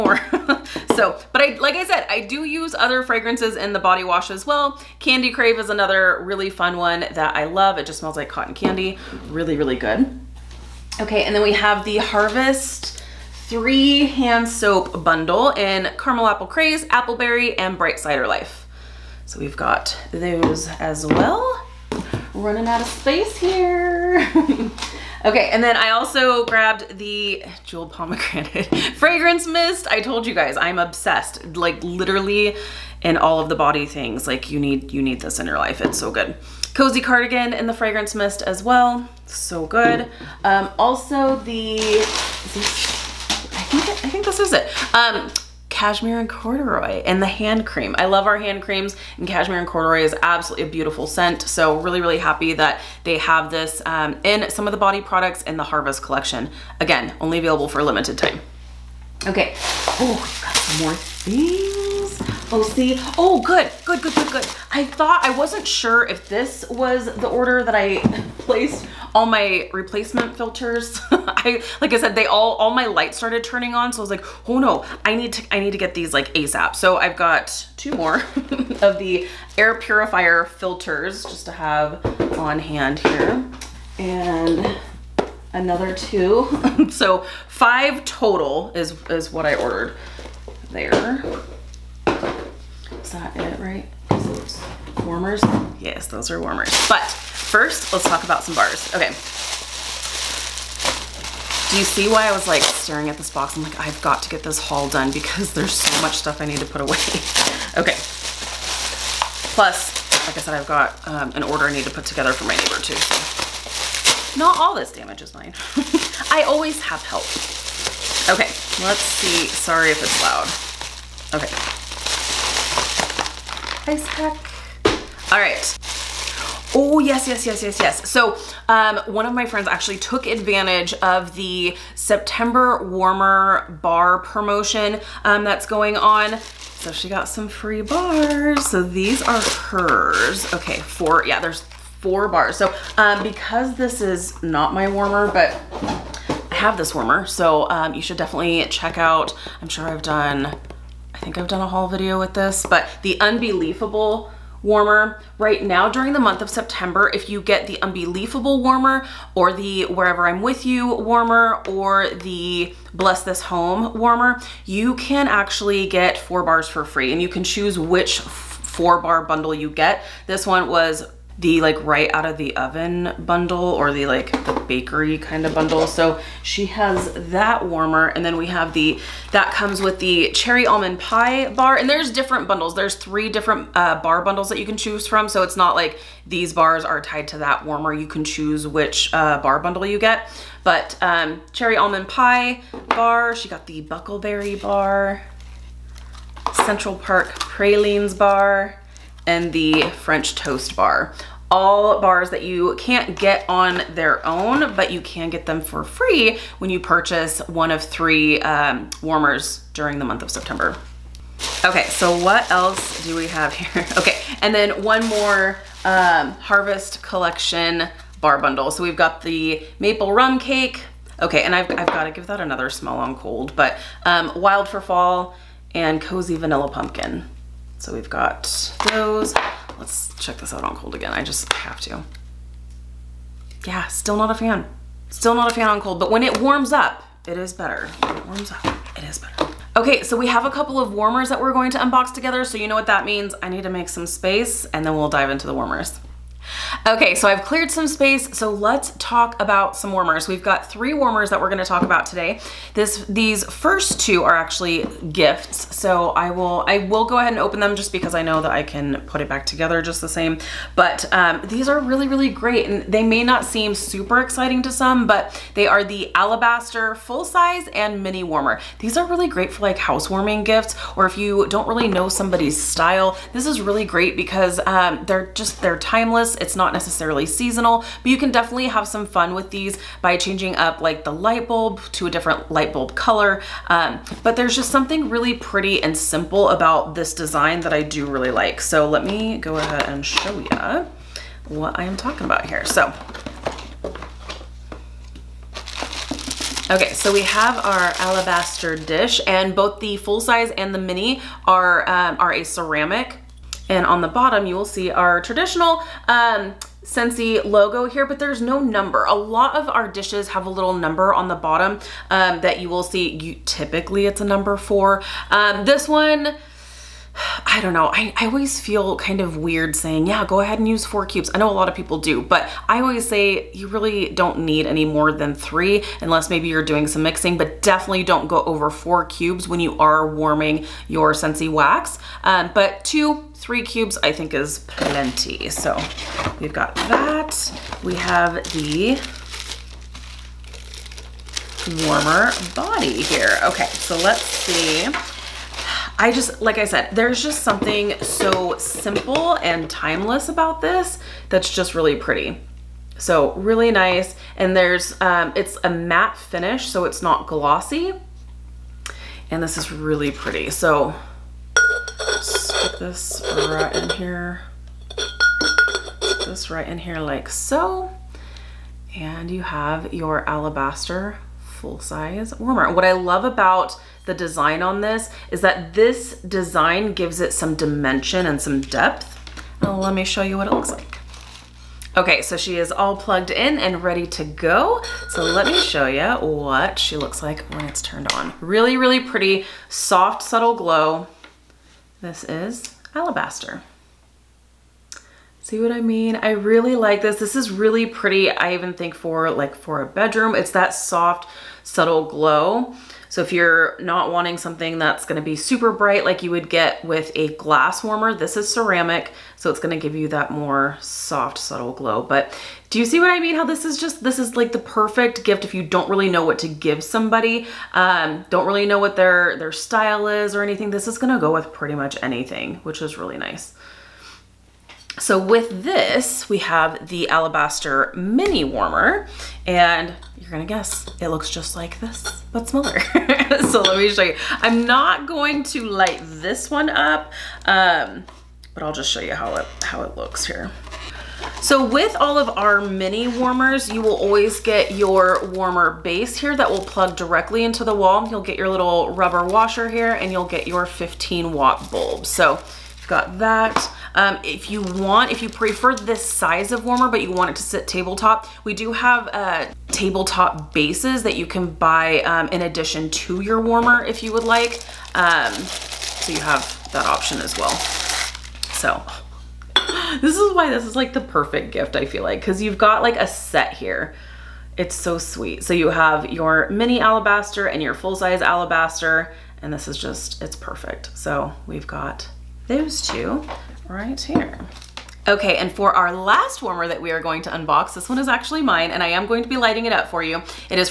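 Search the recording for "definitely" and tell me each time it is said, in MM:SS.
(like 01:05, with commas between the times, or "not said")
02:28, 04:38, 05:27.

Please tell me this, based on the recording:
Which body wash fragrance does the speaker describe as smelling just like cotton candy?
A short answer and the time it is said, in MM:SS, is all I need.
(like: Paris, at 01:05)
Candy Crave, at 00:04.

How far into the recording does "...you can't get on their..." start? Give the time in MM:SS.
03:22.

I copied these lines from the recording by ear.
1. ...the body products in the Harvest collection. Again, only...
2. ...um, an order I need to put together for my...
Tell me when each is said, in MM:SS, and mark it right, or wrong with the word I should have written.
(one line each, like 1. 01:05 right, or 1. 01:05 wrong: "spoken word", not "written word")
1. 00:54 right
2. 01:51 right.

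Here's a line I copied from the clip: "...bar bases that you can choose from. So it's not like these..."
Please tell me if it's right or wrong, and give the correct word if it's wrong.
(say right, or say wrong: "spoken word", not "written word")
wrong: "bundles", not "bases".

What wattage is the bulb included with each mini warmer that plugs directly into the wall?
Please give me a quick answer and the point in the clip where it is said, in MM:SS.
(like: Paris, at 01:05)
15 watt, at 07:30.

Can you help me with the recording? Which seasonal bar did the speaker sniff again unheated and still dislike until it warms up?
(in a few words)
maple rum cake.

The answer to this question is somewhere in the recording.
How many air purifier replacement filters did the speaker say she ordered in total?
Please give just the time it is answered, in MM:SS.
01:27.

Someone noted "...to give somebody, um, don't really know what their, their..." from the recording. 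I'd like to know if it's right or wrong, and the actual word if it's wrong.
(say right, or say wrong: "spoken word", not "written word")
right.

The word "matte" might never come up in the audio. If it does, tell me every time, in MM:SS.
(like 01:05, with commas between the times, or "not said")
05:55.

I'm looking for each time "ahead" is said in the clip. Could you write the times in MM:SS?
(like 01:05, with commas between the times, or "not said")
04:17, 04:49, 05:20.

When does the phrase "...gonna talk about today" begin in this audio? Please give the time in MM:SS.
04:11.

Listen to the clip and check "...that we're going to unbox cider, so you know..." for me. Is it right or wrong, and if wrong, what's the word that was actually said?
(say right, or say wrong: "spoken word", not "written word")
wrong: "together", not "cider".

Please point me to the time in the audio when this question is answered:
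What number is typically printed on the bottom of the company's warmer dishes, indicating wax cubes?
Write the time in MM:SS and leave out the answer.
05:14.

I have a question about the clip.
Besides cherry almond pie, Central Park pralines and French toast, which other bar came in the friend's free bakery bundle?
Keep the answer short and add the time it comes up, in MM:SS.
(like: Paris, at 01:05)
buckleberry, at 03:13.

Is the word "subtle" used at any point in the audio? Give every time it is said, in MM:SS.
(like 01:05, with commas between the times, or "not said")
06:30, 06:41, 06:51.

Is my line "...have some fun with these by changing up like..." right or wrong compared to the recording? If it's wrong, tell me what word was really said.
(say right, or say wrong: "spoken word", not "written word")
right.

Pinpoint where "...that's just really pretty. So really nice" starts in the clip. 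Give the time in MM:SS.
05:51.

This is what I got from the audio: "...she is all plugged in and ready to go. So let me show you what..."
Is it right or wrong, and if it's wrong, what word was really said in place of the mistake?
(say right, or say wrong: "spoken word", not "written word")
right.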